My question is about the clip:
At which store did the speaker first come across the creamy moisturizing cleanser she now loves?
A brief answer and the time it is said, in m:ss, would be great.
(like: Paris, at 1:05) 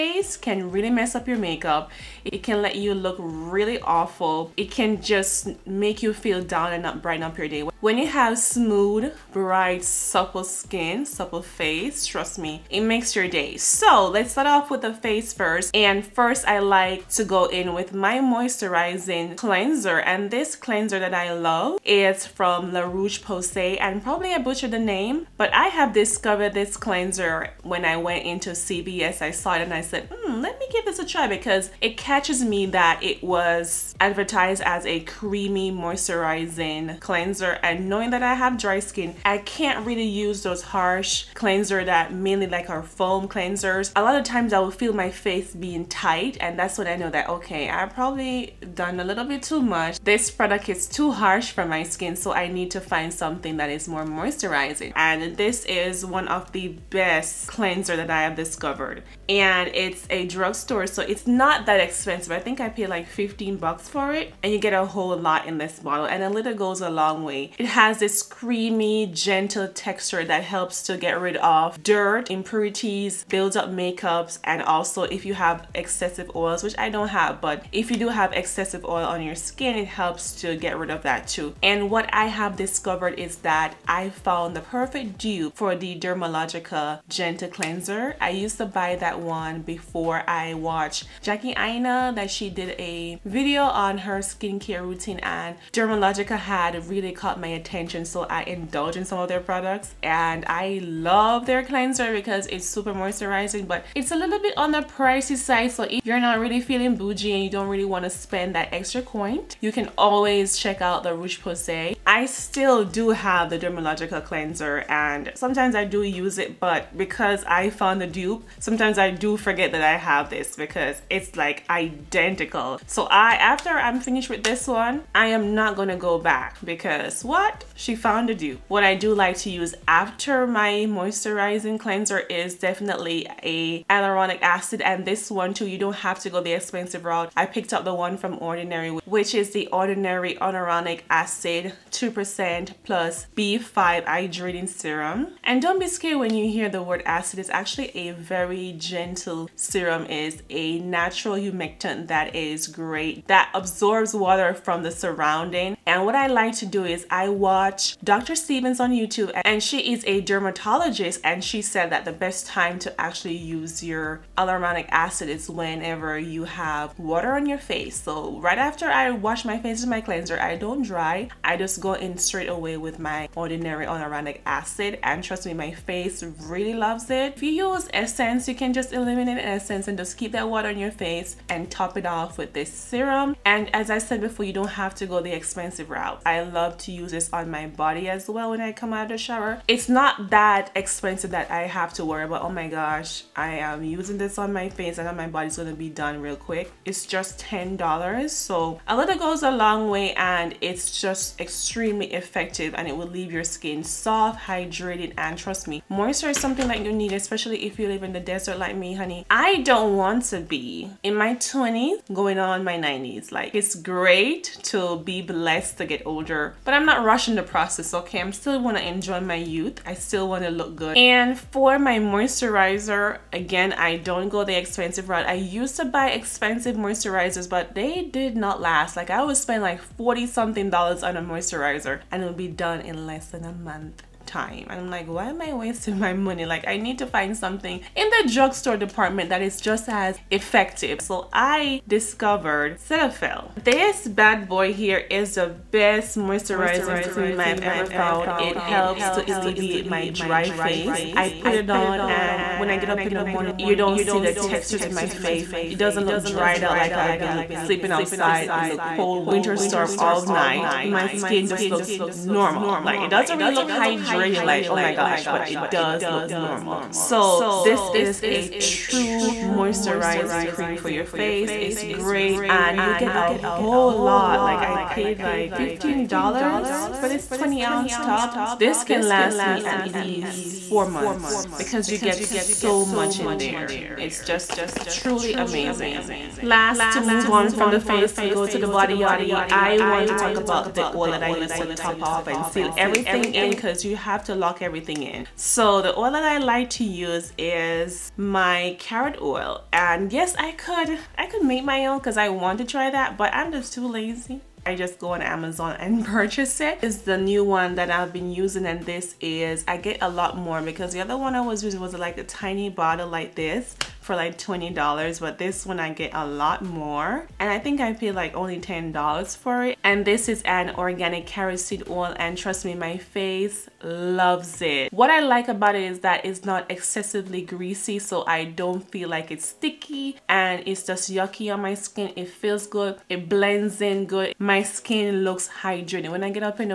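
CVS, at 0:28.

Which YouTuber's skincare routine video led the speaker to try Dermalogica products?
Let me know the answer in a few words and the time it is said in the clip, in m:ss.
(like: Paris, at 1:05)
Jackie Aina, at 1:31.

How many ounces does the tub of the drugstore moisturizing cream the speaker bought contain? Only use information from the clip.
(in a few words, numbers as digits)
20 ounces.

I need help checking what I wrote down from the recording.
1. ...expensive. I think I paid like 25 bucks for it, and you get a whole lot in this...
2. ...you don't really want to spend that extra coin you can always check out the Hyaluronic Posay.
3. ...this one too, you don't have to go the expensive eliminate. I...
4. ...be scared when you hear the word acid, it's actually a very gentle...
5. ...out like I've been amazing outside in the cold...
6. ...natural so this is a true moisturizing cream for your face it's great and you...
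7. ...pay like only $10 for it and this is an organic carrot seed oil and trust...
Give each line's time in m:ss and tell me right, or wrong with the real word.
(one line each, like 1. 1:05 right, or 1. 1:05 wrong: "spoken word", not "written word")
1. 1:01 wrong: "15", not "25"
2. 1:47 wrong: "Rouge", not "Hyaluronic"
3. 2:15 wrong: "route", not "eliminate"
4. 2:25 right
5. 4:16 wrong: "sleeping", not "amazing"
6. 4:26 wrong: "normal", not "natural"
7. 5:17 right.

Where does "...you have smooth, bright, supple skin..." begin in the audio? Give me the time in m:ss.
0:07.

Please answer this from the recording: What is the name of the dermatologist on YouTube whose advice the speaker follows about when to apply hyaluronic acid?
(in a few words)
Dr. Stevens.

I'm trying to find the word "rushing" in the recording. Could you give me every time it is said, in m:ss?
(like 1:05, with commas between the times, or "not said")
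3:37.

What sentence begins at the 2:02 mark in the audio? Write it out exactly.
So I, after I'm finished with this one, I am not gonna go back because what?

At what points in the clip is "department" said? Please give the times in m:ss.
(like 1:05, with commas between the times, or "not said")
3:58.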